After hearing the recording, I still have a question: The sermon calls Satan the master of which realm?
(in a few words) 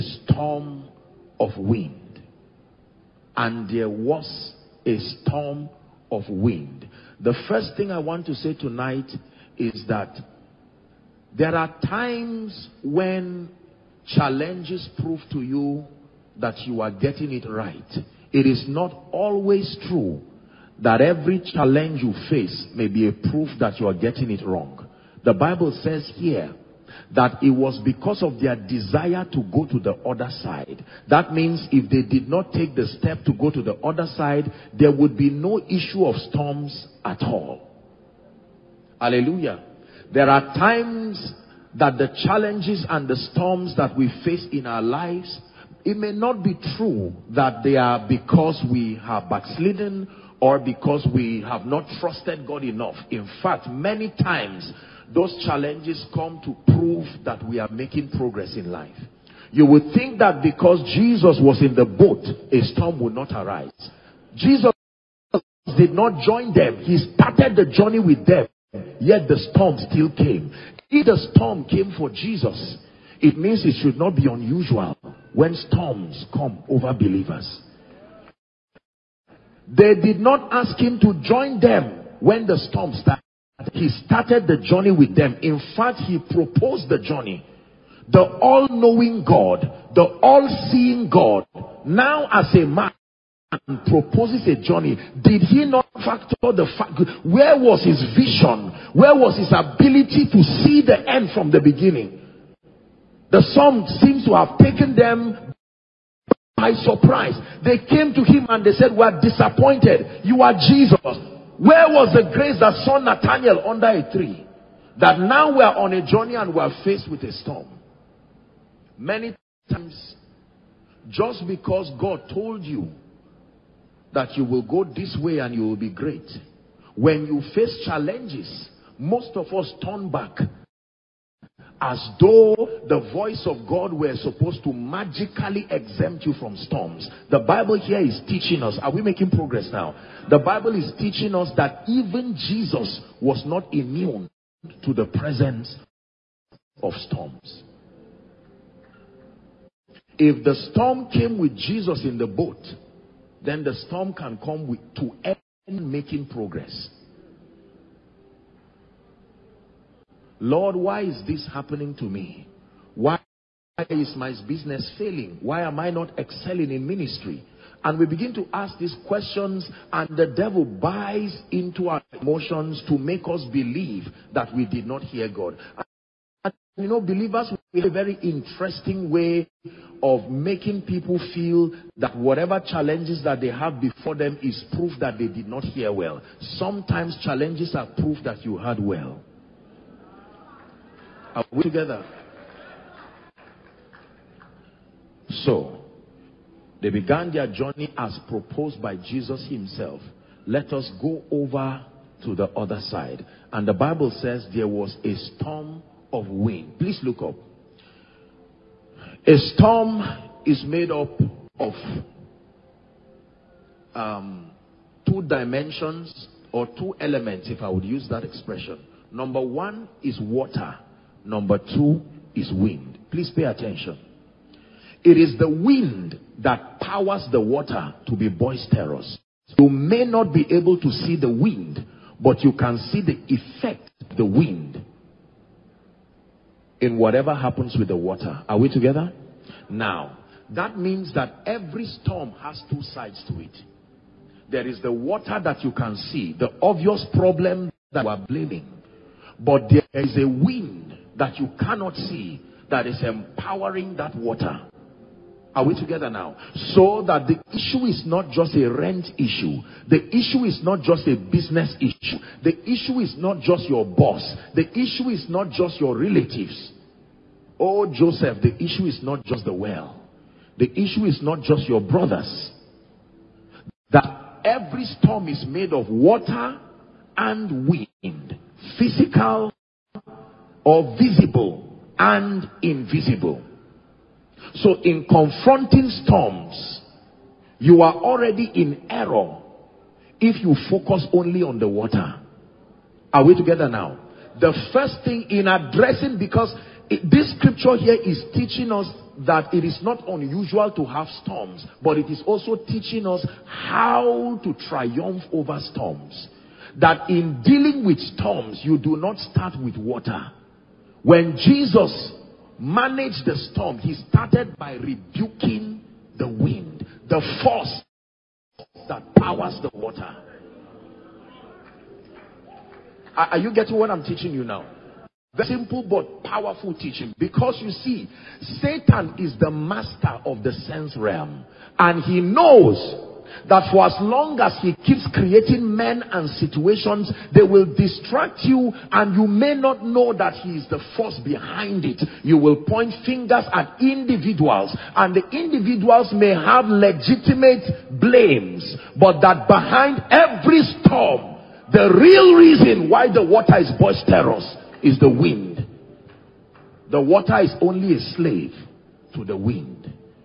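the sense realm.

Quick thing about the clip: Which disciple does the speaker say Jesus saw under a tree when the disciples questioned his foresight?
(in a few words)
Nathaniel.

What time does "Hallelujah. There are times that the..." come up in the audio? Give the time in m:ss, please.
0:38.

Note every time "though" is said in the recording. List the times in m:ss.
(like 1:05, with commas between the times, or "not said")
2:12.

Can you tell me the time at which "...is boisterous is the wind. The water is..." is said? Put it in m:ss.
5:53.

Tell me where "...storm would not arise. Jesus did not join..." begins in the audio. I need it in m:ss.
1:02.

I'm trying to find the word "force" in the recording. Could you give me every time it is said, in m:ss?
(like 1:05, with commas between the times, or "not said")
5:17, 5:40.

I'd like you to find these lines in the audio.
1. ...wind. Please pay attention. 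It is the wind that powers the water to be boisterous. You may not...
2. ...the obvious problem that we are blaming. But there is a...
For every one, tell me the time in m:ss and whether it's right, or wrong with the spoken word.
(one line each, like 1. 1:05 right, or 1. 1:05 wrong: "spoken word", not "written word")
1. 3:42 right
2. 4:06 right.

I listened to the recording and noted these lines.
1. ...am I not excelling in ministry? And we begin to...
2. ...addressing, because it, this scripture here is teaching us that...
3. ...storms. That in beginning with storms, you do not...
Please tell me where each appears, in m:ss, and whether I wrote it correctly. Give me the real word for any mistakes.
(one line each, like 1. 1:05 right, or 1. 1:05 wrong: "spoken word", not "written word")
1. 2:45 right
2. 4:55 right
3. 5:05 wrong: "dealing", not "beginning".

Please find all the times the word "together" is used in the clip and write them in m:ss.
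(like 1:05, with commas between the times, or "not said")
3:11, 3:58, 4:15, 4:53.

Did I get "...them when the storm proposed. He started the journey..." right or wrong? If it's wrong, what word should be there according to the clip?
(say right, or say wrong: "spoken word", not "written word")
wrong: "started", not "proposed".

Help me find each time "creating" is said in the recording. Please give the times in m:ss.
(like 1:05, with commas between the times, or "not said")
5:35.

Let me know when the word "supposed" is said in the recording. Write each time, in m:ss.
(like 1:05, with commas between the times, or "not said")
2:14.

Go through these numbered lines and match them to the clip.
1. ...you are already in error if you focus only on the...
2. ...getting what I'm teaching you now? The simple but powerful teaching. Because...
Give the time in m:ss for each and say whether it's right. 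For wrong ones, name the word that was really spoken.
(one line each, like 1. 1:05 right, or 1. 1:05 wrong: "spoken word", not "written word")
1. 4:47 right
2. 5:23 right.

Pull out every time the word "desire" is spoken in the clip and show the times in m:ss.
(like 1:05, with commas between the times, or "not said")
0:28.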